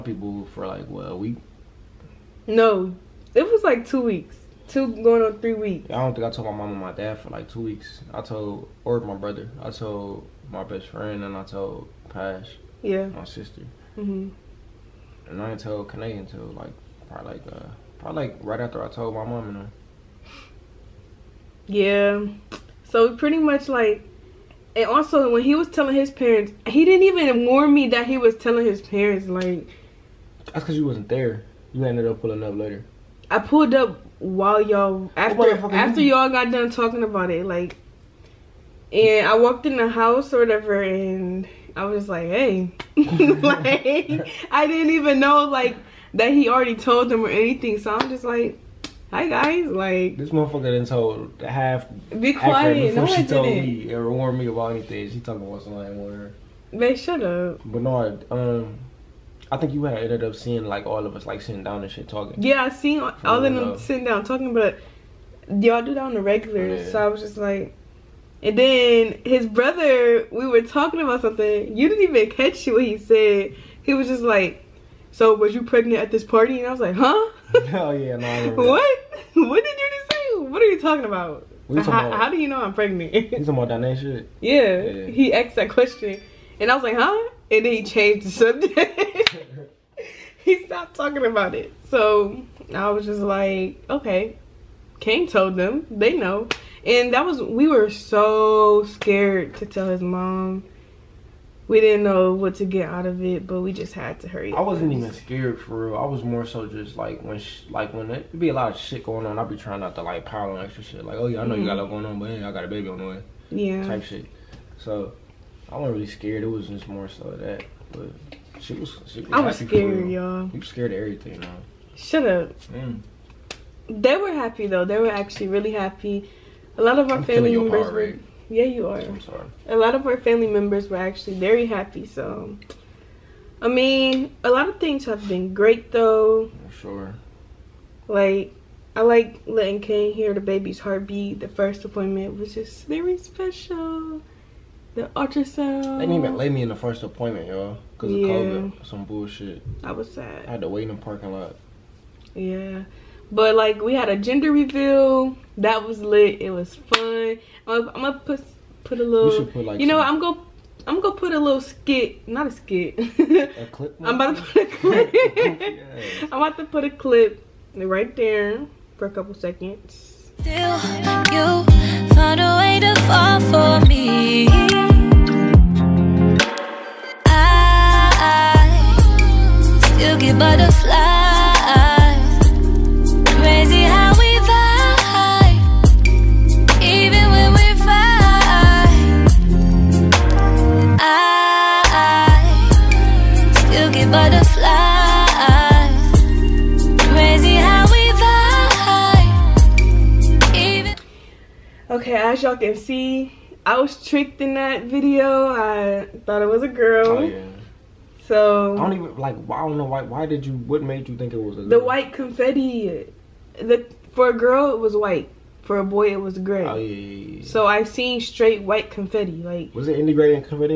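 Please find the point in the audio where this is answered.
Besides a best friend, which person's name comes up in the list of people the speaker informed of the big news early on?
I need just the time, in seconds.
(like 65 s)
12 s.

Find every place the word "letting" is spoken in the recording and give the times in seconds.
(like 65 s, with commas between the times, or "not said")
139 s.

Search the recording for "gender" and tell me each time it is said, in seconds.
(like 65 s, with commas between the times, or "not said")
154 s.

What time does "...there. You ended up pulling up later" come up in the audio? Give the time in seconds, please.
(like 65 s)
31 s.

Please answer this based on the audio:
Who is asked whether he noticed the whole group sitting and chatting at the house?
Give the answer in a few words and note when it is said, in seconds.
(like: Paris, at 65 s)
Bernard, at 57 s.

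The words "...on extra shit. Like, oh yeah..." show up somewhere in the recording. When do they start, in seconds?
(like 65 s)
110 s.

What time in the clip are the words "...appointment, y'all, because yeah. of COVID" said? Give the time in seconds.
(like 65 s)
147 s.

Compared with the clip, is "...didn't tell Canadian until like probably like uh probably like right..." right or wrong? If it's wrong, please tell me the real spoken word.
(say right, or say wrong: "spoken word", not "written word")
right.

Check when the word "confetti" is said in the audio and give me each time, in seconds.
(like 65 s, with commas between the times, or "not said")
212 s, 218 s.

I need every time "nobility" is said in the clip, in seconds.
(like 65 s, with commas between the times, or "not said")
not said.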